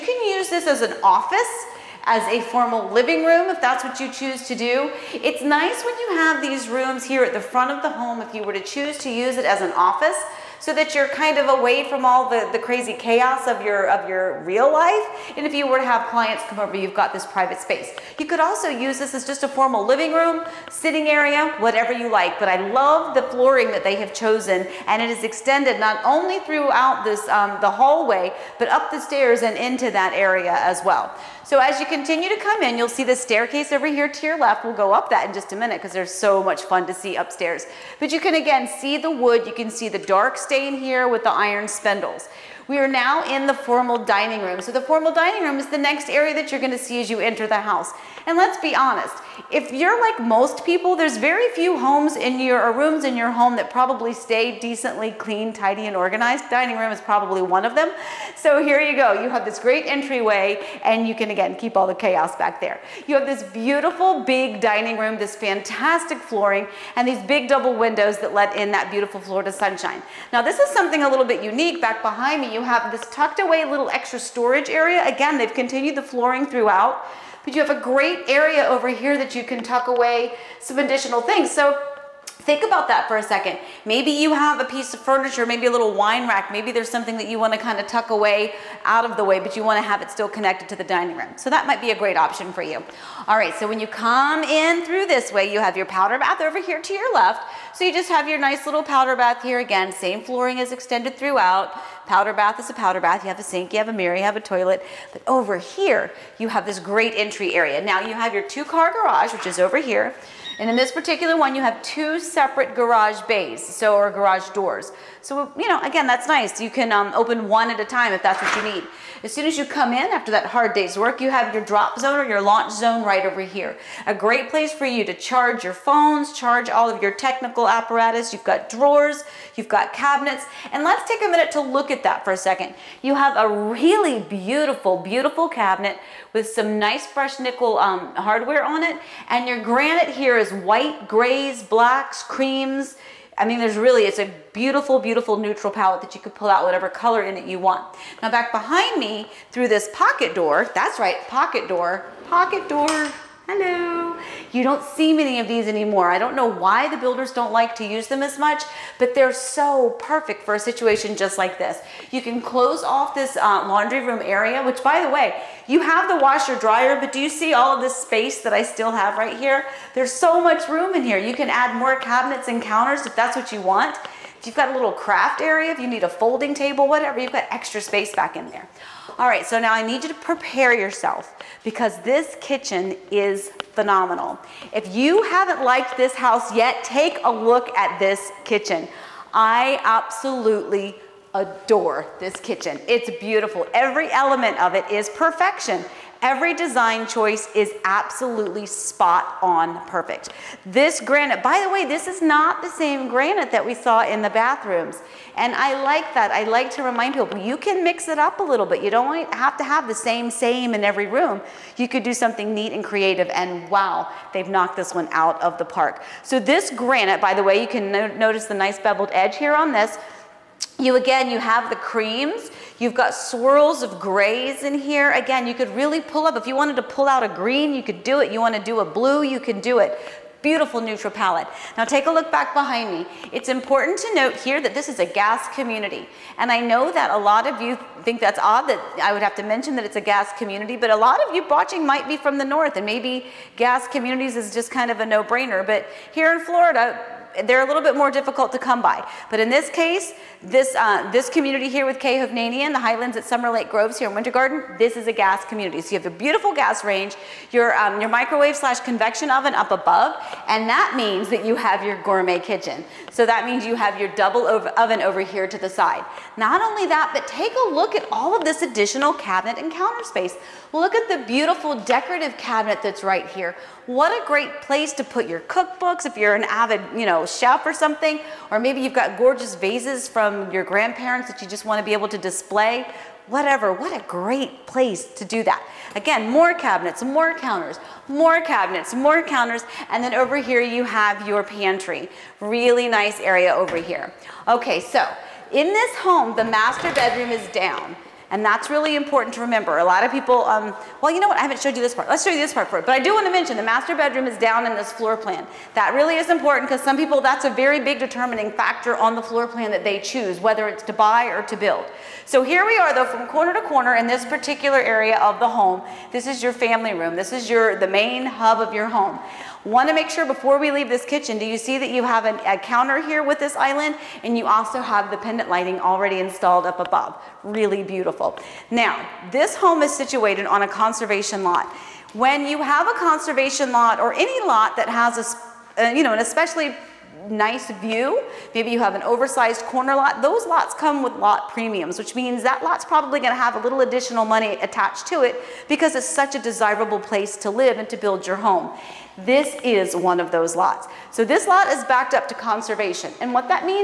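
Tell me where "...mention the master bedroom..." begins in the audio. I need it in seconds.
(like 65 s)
303 s.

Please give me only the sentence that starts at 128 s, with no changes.
You've got drawers, you've got cabinets.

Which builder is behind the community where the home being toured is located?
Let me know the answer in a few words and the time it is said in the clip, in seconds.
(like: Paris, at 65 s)
K. Hovnanian, at 251 s.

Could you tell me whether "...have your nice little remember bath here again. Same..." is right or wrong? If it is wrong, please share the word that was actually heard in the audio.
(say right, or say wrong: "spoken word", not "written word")
wrong: "powder", not "remember".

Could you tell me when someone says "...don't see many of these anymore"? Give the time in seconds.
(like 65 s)
154 s.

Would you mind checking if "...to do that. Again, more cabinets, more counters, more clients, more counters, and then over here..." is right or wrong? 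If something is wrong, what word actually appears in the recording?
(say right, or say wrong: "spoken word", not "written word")
wrong: "cabinets", not "clients".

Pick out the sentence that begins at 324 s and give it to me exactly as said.
And you also have the pendant lighting already installed up above.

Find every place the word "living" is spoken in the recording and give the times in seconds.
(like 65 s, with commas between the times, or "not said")
2 s, 19 s.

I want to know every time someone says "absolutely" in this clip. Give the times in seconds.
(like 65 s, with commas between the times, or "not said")
189 s, 197 s.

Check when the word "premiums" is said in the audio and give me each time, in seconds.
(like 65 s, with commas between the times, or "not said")
341 s.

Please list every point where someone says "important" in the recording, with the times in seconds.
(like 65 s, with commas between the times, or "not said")
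233 s, 298 s, 306 s.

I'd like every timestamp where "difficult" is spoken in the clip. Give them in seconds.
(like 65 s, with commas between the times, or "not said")
248 s.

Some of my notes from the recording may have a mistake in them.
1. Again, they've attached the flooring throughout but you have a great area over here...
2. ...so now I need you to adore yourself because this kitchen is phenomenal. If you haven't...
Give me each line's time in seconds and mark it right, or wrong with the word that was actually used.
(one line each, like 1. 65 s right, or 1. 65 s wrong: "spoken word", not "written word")
1. 75 s wrong: "continued", not "attached"
2. 179 s wrong: "prepare", not "adore".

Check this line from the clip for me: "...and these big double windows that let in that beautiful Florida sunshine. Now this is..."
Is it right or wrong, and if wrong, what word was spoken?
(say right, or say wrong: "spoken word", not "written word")
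right.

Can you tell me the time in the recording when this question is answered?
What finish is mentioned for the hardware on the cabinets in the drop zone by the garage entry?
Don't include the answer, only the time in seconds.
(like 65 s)
137 s.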